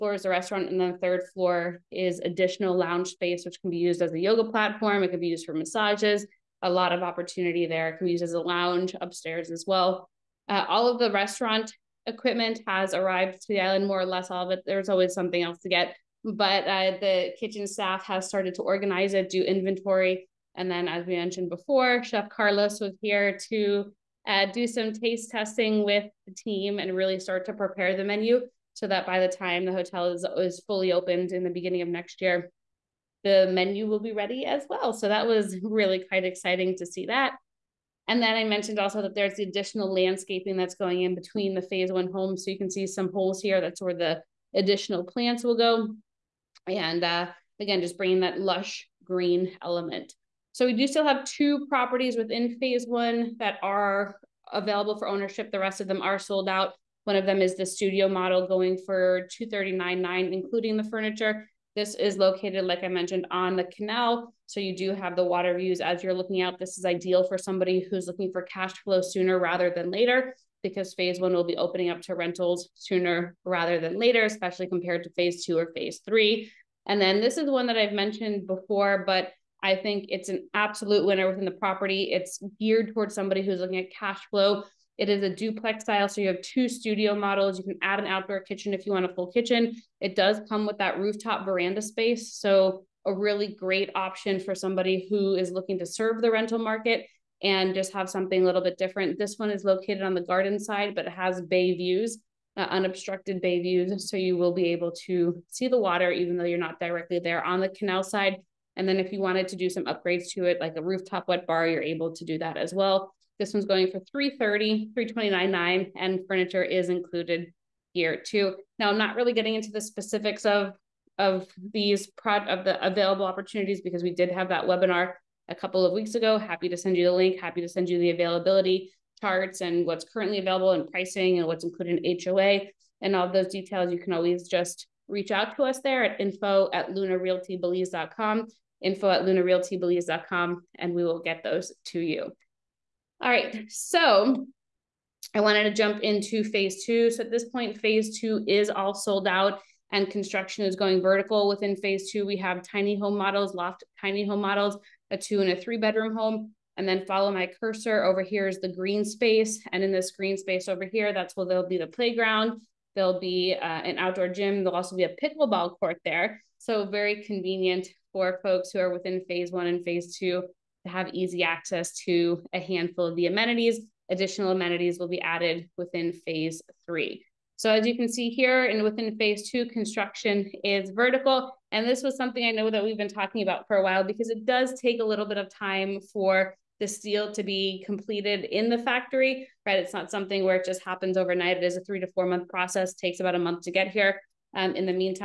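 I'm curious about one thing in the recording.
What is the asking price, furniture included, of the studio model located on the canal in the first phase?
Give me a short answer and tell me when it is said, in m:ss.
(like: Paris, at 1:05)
$239,900, at 0:59.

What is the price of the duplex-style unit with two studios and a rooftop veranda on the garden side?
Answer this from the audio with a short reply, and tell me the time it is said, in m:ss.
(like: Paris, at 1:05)
$329,900, at 1:54.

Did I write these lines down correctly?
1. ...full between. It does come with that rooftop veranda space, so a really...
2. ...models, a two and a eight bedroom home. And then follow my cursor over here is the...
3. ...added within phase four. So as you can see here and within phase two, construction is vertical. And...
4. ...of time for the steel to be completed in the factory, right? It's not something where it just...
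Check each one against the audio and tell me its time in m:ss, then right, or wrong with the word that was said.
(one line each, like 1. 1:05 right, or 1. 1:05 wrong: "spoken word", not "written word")
1. 1:29 wrong: "kitchen", not "between"
2. 2:34 wrong: "three", not "eight"
3. 2:55 wrong: "three", not "four"
4. 3:05 right.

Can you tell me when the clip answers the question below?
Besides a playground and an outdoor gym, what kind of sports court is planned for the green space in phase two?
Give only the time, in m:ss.
2:45.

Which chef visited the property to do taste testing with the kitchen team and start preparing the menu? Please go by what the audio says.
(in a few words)
Chef Carlos.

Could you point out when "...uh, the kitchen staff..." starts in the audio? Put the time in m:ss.
0:16.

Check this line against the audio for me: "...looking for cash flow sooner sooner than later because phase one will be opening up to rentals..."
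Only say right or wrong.
wrong.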